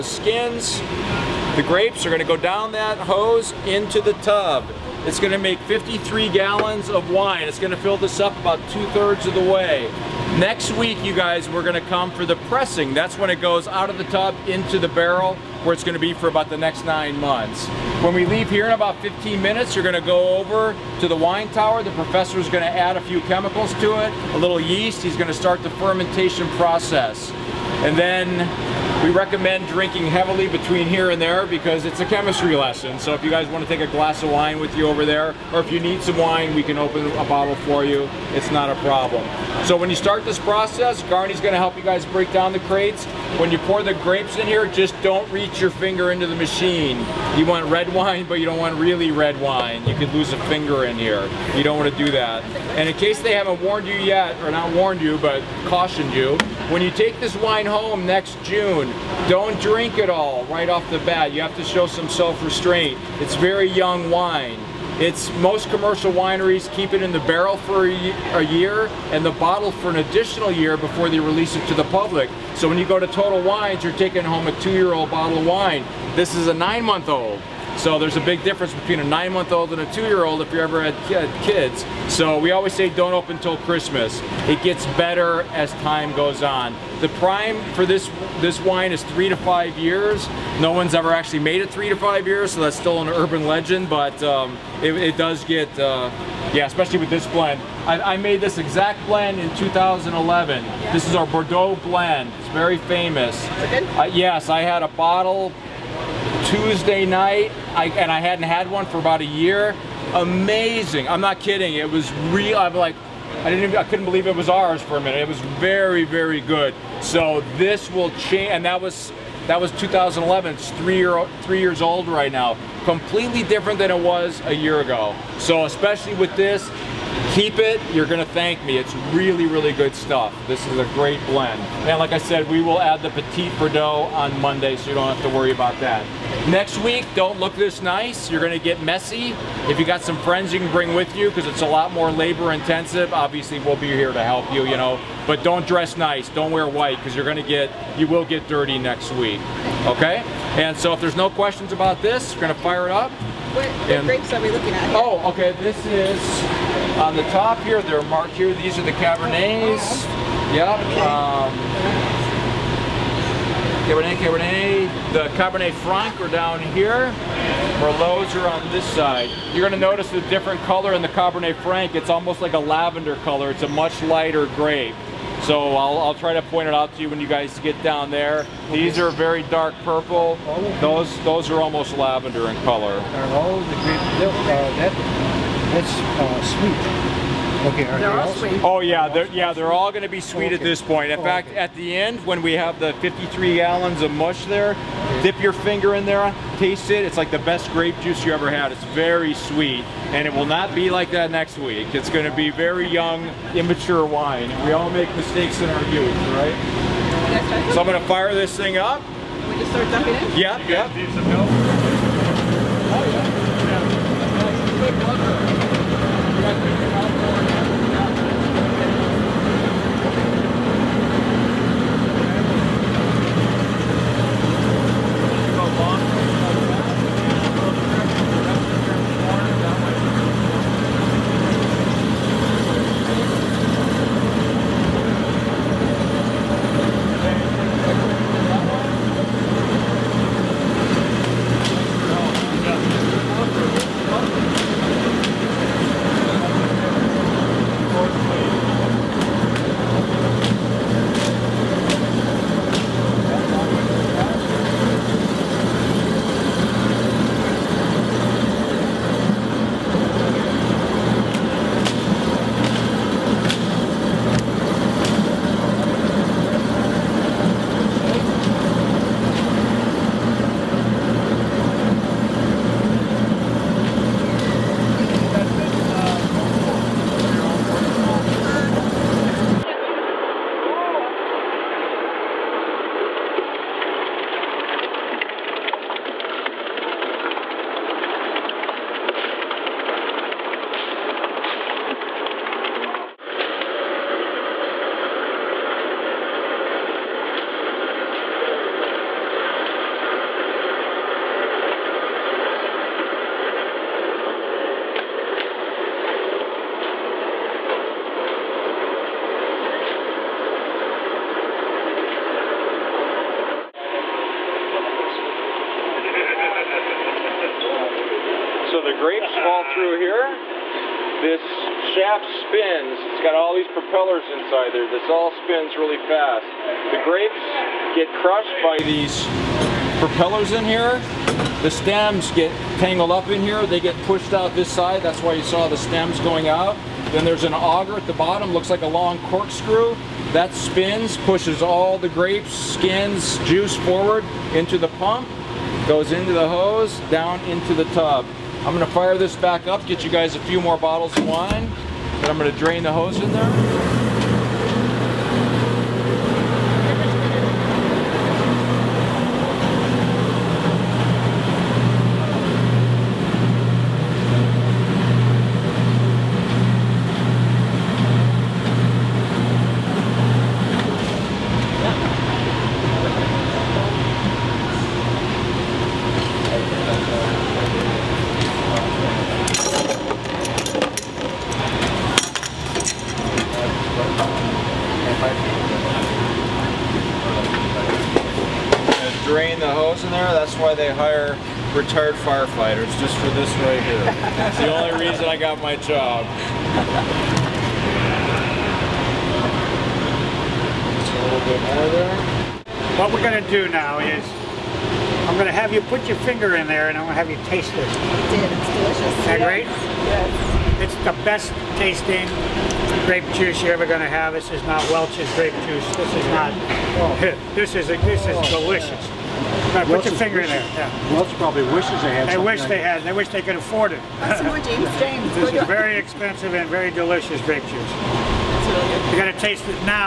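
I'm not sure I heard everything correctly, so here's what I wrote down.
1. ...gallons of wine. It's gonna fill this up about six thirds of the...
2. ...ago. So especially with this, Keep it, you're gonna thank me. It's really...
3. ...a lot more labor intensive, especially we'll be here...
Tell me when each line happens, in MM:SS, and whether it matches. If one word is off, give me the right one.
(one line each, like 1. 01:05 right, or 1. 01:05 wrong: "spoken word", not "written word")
1. 00:06 wrong: "two", not "six"
2. 02:04 right
3. 02:21 wrong: "obviously", not "especially".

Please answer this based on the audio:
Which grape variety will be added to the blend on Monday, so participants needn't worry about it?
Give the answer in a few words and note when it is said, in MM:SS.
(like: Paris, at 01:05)
Petit Verdot, at 02:13.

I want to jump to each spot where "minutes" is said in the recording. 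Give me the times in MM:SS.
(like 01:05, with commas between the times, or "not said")
00:19, 01:54.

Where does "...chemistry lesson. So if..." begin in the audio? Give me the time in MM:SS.
00:32.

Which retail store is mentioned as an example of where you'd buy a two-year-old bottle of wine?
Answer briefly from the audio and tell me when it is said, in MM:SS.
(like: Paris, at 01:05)
Total Wines, at 01:13.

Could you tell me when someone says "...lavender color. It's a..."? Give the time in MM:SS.
02:52.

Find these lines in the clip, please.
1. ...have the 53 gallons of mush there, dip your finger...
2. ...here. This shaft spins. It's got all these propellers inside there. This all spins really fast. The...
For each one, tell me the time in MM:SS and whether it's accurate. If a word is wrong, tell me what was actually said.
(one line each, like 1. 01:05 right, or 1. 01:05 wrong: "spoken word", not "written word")
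1. 03:12 right
2. 05:19 right.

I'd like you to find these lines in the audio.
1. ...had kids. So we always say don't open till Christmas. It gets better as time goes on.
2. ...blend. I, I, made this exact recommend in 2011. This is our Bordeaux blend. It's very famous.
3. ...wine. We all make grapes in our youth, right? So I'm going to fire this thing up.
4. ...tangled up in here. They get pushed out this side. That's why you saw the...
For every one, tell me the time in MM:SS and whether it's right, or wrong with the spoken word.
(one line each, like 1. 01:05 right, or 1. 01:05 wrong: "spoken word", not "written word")
1. 01:20 right
2. 01:37 wrong: "blend", not "recommend"
3. 03:24 wrong: "mistakes", not "grapes"
4. 05:32 right.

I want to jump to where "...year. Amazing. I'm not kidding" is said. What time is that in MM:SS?
01:49.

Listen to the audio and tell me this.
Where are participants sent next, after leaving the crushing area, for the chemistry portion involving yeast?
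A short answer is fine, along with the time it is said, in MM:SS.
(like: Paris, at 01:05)
the wine tower, at 00:21.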